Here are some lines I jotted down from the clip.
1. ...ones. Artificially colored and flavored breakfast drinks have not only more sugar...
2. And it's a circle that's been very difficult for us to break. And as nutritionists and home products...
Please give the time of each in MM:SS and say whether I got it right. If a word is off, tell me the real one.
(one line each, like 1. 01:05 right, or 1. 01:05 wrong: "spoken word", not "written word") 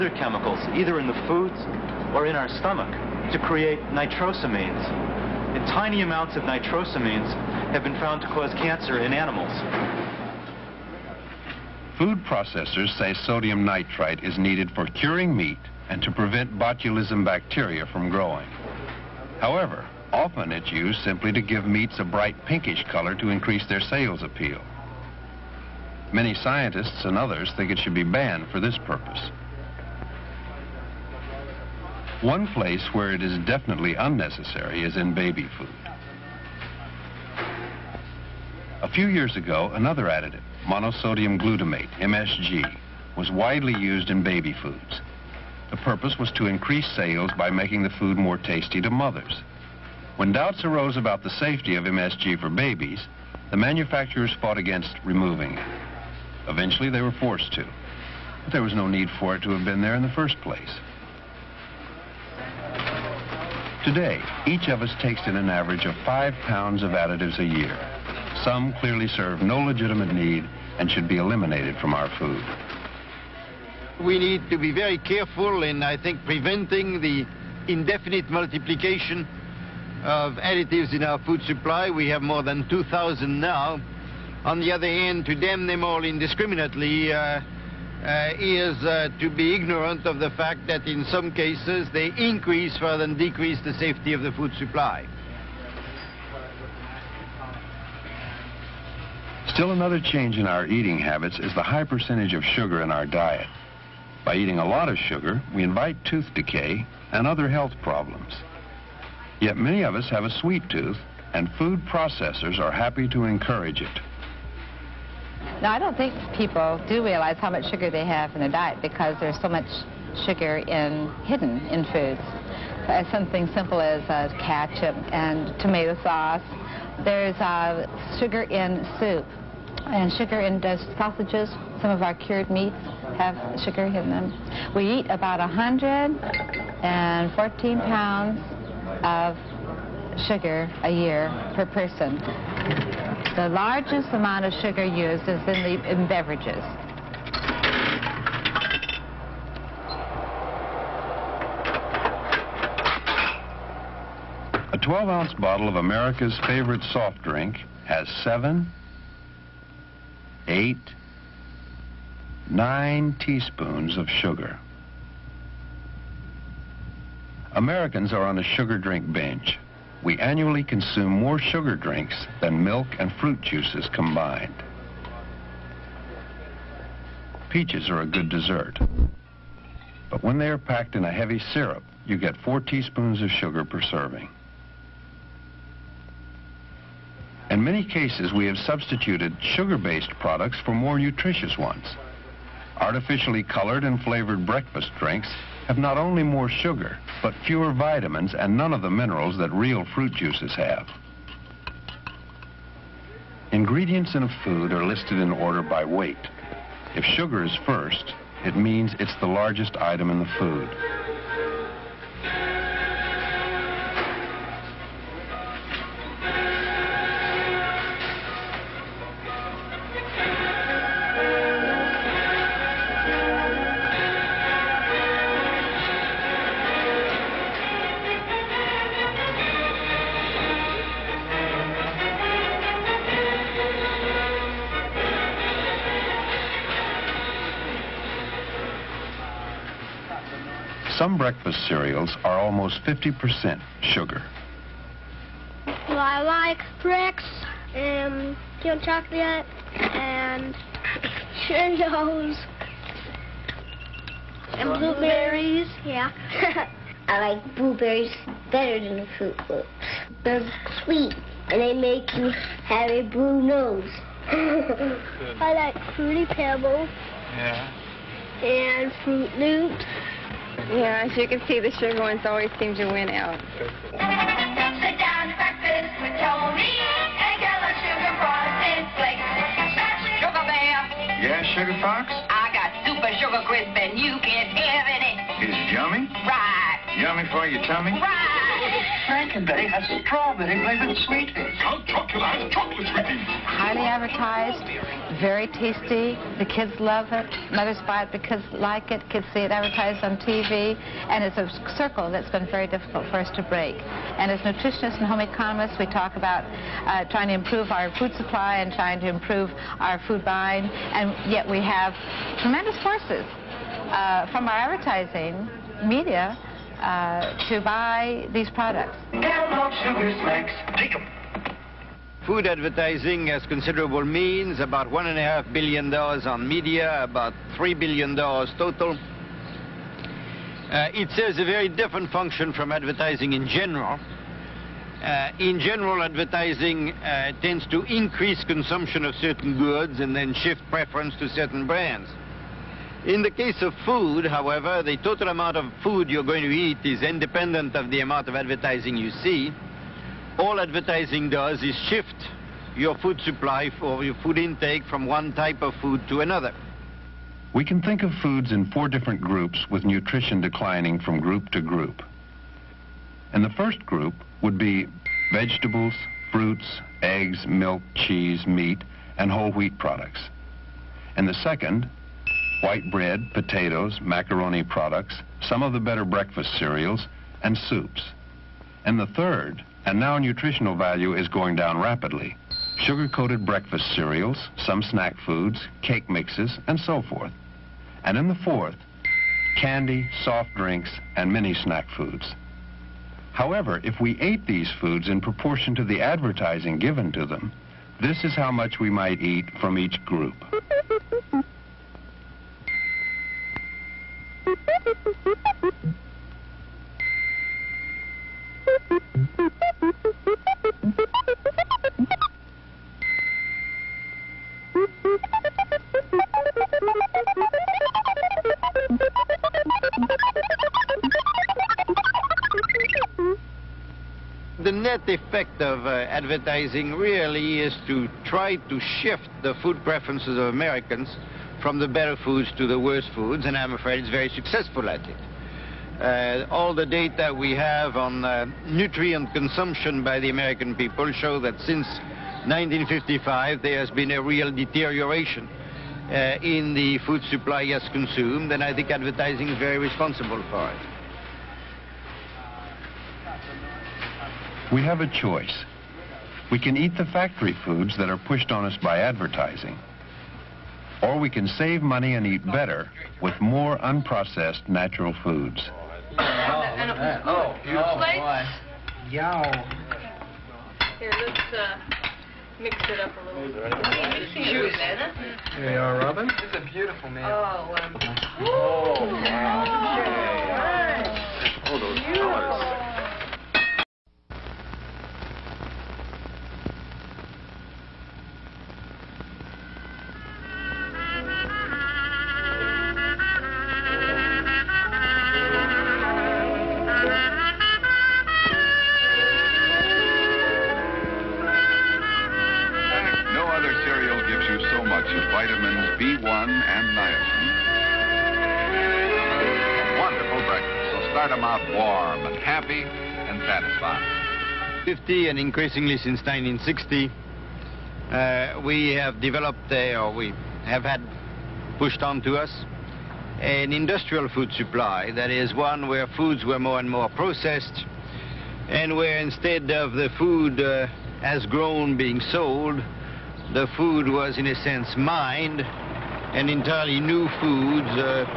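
1. 03:11 right
2. 05:01 wrong: "economists", not "products".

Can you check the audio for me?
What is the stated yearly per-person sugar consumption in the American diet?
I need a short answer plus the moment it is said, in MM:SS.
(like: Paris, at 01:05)
114 pounds, at 02:15.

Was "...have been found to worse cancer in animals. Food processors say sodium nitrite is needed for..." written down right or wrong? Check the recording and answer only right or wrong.
wrong.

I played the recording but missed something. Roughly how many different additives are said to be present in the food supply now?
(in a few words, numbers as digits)
more than 2,000.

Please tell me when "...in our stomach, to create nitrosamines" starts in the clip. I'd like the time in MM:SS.
00:02.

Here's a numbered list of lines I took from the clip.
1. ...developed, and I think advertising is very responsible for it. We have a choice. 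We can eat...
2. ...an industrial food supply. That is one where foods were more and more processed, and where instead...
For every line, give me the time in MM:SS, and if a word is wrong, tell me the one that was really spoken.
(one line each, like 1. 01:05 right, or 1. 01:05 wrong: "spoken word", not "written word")
1. 07:27 wrong: "consumed", not "developed"
2. 08:43 right.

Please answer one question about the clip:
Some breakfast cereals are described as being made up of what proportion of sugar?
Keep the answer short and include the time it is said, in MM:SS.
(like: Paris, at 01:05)
almost 50%, at 04:02.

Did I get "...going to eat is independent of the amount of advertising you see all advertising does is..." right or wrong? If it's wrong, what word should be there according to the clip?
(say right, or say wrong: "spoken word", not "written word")
right.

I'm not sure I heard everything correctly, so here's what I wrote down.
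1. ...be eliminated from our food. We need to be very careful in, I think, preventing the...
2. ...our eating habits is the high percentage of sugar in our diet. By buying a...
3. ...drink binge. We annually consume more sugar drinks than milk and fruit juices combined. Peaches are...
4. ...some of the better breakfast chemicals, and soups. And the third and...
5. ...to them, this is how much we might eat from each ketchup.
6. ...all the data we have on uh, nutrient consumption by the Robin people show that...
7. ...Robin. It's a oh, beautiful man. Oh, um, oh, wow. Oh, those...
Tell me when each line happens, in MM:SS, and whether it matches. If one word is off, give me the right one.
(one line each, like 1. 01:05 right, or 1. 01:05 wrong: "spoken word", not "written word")
1. 01:11 right
2. 01:40 wrong: "eating", not "buying"
3. 02:48 right
4. 06:15 wrong: "cereals", not "chemicals"
5. 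06:37 wrong: "group", not "ketchup"
6. 07:16 wrong: "American", not "Robin"
7. 07:55 right.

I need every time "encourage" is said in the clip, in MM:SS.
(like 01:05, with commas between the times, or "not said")
01:53.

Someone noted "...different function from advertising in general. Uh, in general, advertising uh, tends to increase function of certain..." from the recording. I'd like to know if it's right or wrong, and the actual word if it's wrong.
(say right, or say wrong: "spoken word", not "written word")
wrong: "consumption", not "function".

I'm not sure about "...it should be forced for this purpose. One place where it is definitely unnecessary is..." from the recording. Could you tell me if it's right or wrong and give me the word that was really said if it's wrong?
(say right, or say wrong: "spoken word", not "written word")
wrong: "banned", not "forced".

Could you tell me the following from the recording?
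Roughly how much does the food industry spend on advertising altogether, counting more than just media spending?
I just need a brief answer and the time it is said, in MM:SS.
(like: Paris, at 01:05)
3 billion dollars, at 05:27.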